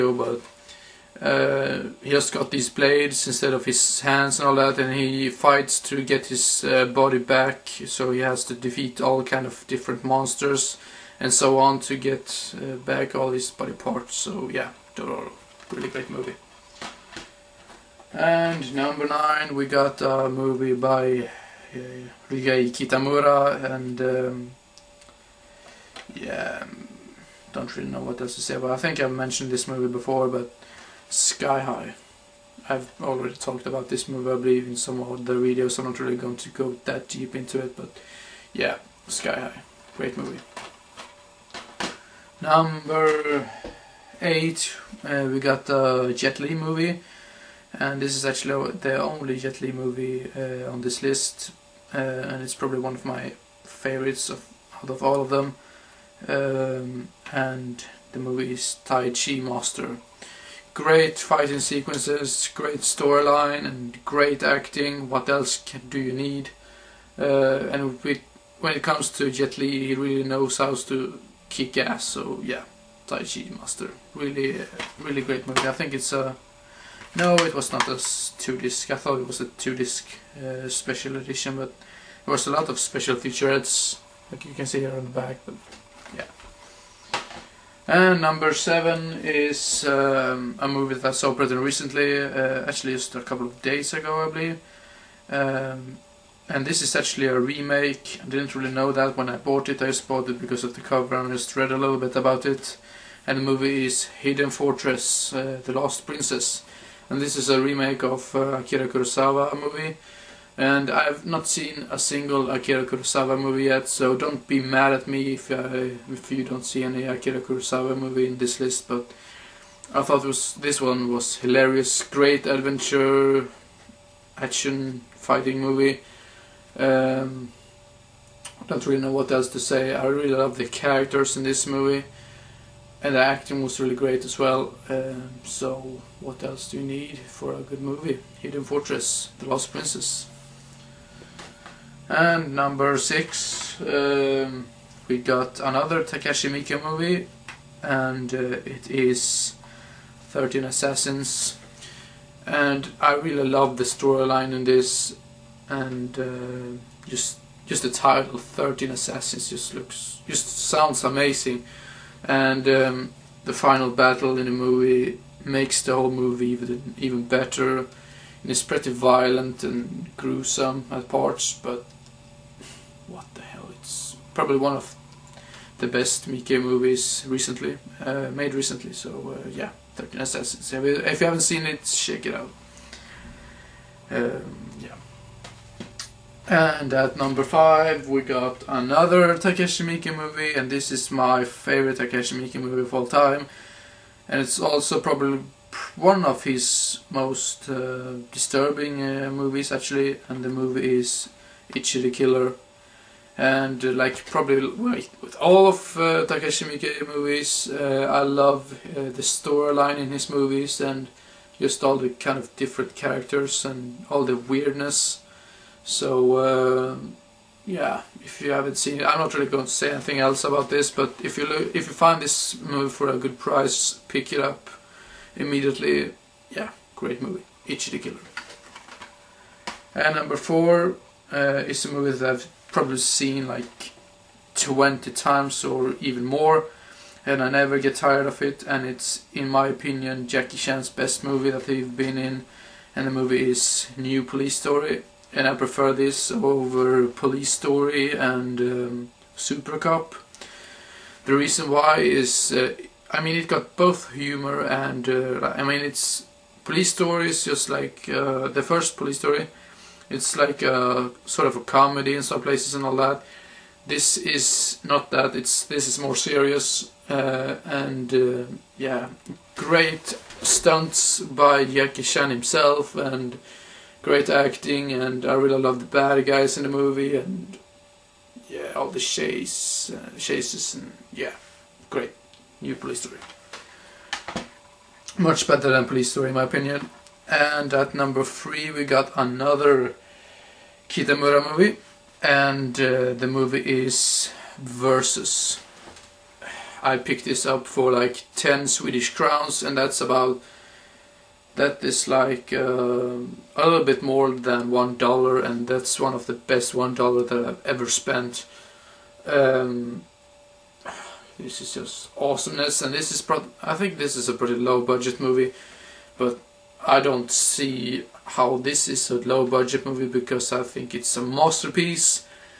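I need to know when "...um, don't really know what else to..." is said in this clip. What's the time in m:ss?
2:06.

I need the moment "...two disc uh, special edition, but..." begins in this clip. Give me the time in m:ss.
1:19.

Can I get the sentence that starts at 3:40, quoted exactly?
But if you look, if you find this movie for a good price, pick it up immediately.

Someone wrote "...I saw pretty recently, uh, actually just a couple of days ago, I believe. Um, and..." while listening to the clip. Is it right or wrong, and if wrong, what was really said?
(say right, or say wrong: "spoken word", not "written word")
right.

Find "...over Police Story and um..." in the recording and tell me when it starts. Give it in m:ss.
4:06.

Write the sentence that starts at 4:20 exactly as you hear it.
It's like a sort of a comedy in some places and all that.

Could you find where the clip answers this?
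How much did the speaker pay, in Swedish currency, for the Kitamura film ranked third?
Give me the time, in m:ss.
4:58.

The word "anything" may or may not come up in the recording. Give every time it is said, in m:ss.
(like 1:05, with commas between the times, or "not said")
3:39.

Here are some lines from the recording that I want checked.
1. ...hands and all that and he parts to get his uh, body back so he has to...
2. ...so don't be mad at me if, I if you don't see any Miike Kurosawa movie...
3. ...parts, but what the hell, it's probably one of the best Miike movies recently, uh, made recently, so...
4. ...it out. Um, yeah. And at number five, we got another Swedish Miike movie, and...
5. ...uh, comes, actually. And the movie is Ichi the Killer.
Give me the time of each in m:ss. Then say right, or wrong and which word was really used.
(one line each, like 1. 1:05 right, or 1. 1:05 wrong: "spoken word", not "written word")
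1. 0:03 wrong: "fights", not "parts"
2. 1:53 wrong: "Akira", not "Miike"
3. 2:51 right
4. 3:02 wrong: "Takeshi", not "Swedish"
5. 3:19 wrong: "movies", not "comes".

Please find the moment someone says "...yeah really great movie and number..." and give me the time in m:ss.
0:14.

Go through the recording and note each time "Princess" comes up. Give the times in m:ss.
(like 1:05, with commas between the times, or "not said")
1:46, 2:19.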